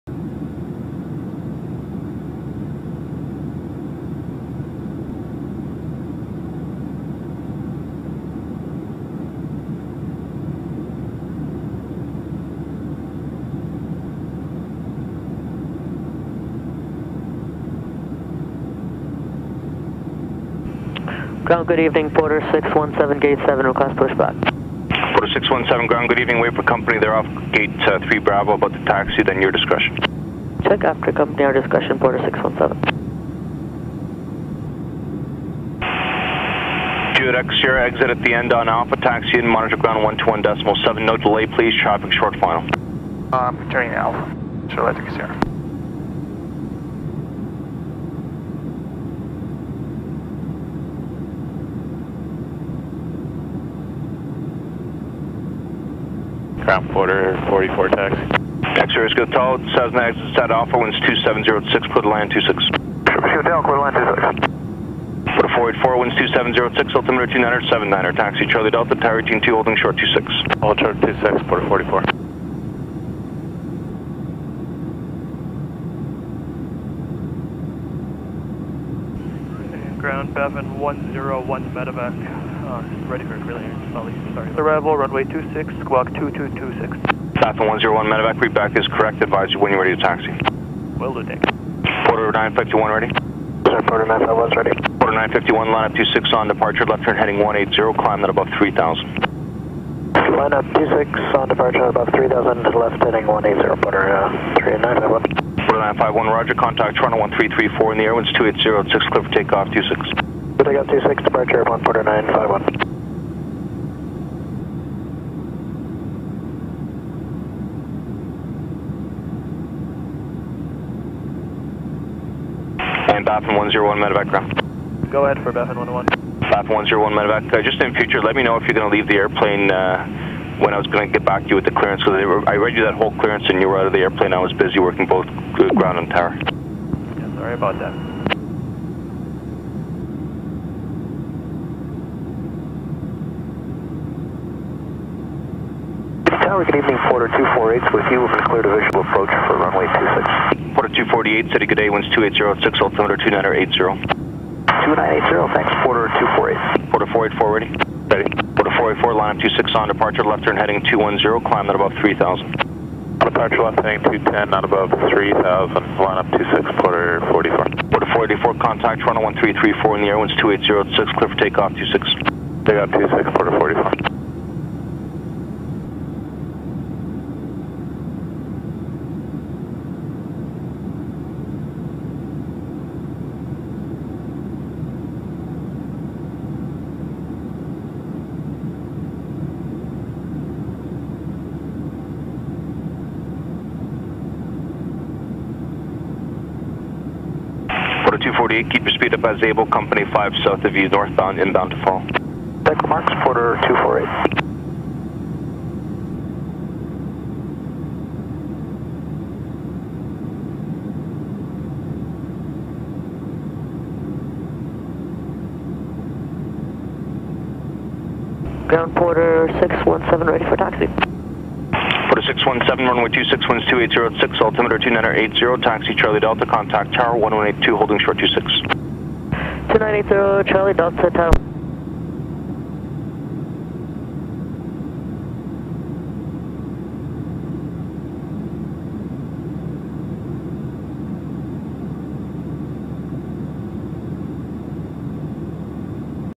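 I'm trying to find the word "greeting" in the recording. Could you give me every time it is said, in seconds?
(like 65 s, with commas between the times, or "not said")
not said.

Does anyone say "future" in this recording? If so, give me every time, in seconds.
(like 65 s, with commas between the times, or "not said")
127 s.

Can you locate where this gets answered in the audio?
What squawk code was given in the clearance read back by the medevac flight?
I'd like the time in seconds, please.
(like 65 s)
85 s.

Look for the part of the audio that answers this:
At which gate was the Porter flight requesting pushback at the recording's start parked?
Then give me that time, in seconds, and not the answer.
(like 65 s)
23 s.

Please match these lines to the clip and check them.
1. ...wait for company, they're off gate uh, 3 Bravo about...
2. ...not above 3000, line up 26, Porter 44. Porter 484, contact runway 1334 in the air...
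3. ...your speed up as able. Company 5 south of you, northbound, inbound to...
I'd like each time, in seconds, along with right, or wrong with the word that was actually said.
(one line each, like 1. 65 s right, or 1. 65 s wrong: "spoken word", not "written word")
1. 26 s right
2. 164 s right
3. 198 s right.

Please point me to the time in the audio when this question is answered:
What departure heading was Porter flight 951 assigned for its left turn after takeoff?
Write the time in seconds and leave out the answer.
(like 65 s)
96 s.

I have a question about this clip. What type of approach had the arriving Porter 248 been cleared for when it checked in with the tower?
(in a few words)
Visual approach.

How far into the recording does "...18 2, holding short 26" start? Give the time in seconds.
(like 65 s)
69 s.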